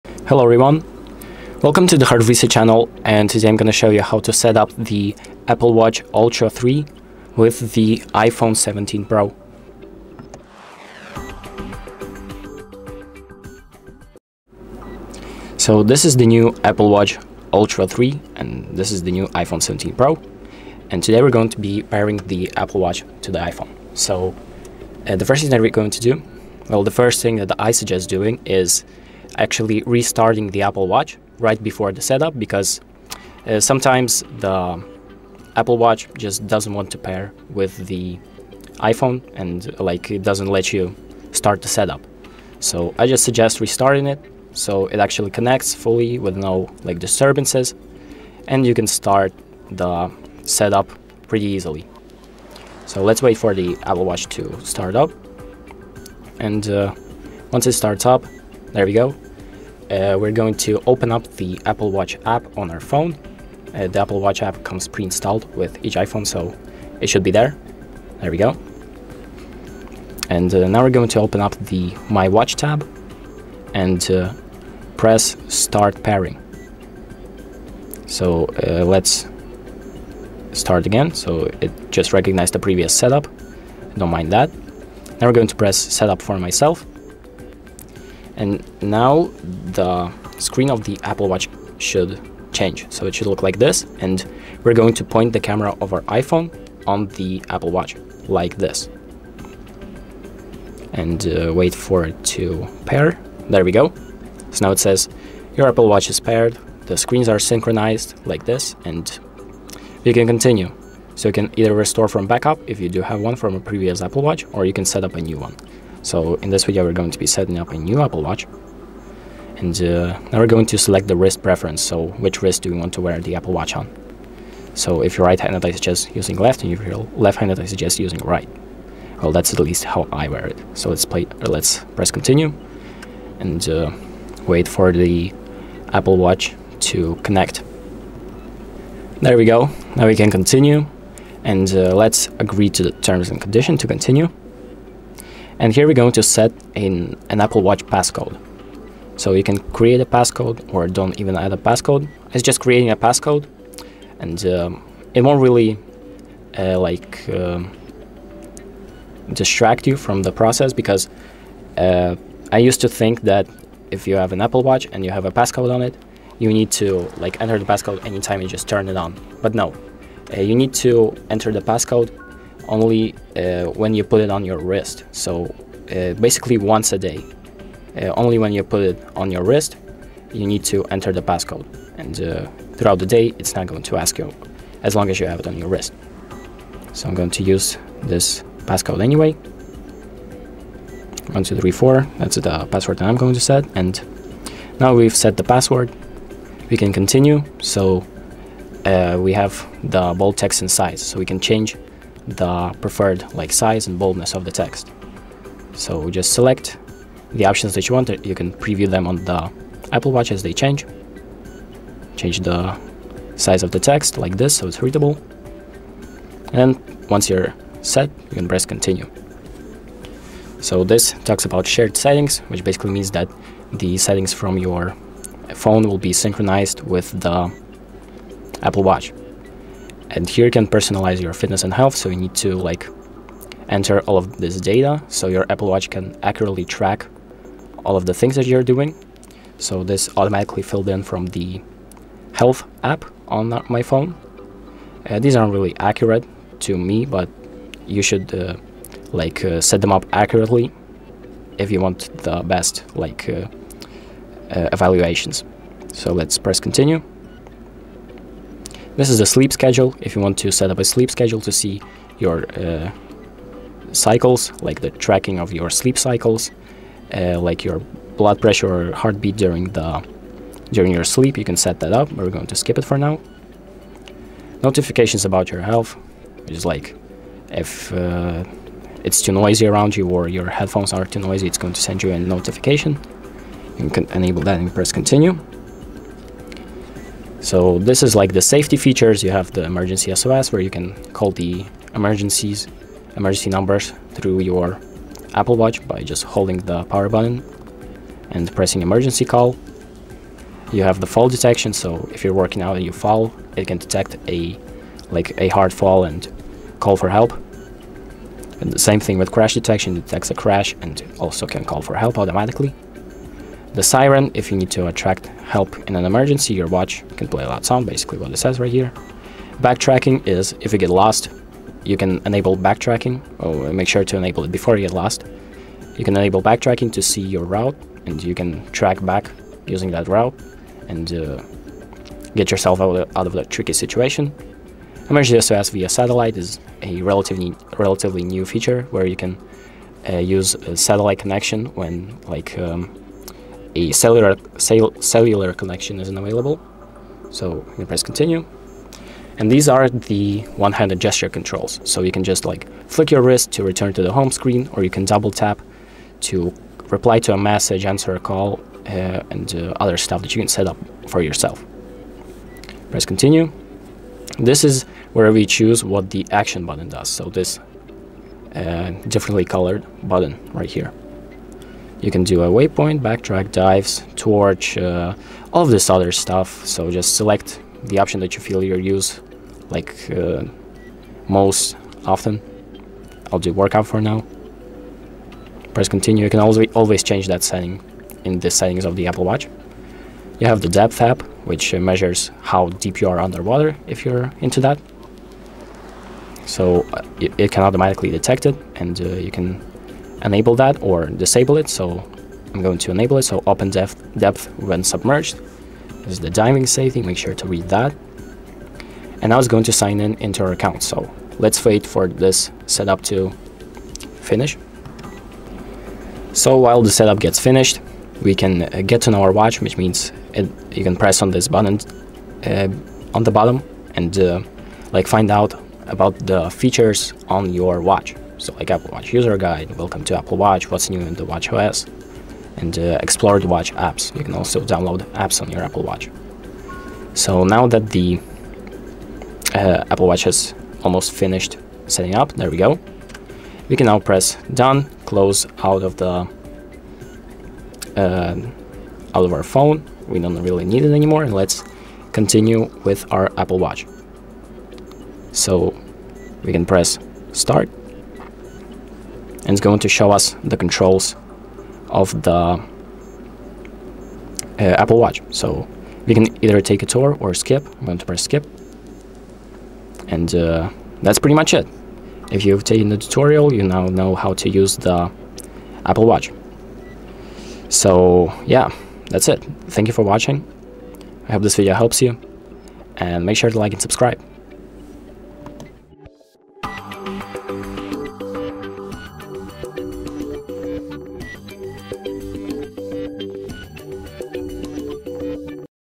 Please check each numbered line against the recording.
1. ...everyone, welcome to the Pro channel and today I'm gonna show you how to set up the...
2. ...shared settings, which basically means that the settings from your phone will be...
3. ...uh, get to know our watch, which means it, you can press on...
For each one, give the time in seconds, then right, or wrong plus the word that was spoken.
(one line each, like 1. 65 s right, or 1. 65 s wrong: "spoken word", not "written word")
1. 0 s wrong: "Visa", not "Pro"
2. 221 s right
3. 418 s right.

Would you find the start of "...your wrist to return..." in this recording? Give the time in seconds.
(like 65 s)
353 s.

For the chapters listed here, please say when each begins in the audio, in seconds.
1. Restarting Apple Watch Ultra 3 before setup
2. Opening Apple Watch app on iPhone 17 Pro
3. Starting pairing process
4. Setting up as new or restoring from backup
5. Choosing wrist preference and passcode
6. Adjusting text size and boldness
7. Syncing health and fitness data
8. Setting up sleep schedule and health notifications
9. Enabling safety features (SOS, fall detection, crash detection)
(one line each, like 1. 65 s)
1. 21 s
2. 52 s
3. 73 s
4. 91 s
5. 118 s
6. 143 s
7. 162 s
8. 198 s
9. 229 s.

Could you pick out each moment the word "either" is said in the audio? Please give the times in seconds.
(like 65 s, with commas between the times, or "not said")
111 s, 466 s.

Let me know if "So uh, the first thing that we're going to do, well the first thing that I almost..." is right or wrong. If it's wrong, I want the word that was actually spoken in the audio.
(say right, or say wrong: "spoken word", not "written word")
wrong: "suggest", not "almost".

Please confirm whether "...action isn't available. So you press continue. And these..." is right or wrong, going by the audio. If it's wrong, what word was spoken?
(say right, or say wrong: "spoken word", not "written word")
wrong: "connection", not "action".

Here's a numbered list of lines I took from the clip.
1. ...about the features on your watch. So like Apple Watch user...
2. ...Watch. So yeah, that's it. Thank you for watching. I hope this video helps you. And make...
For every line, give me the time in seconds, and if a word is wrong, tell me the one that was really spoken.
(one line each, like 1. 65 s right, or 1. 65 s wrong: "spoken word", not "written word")
1. 425 s right
2. 476 s right.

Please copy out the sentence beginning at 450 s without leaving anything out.
We don't really need it anymore.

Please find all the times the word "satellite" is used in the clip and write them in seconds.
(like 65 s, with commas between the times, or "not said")
335 s, 340 s.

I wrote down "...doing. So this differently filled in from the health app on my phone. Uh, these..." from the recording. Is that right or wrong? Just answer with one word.
wrong.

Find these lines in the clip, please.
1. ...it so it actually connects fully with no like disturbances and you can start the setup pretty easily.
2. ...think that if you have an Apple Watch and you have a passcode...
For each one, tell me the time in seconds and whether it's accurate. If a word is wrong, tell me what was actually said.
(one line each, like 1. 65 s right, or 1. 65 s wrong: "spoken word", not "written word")
1. 44 s right
2. 162 s right.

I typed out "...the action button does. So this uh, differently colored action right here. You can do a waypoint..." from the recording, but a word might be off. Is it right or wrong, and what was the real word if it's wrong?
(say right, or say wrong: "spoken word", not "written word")
wrong: "button", not "action".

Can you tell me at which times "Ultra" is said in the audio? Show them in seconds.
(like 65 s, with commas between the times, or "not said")
6 s, 17 s.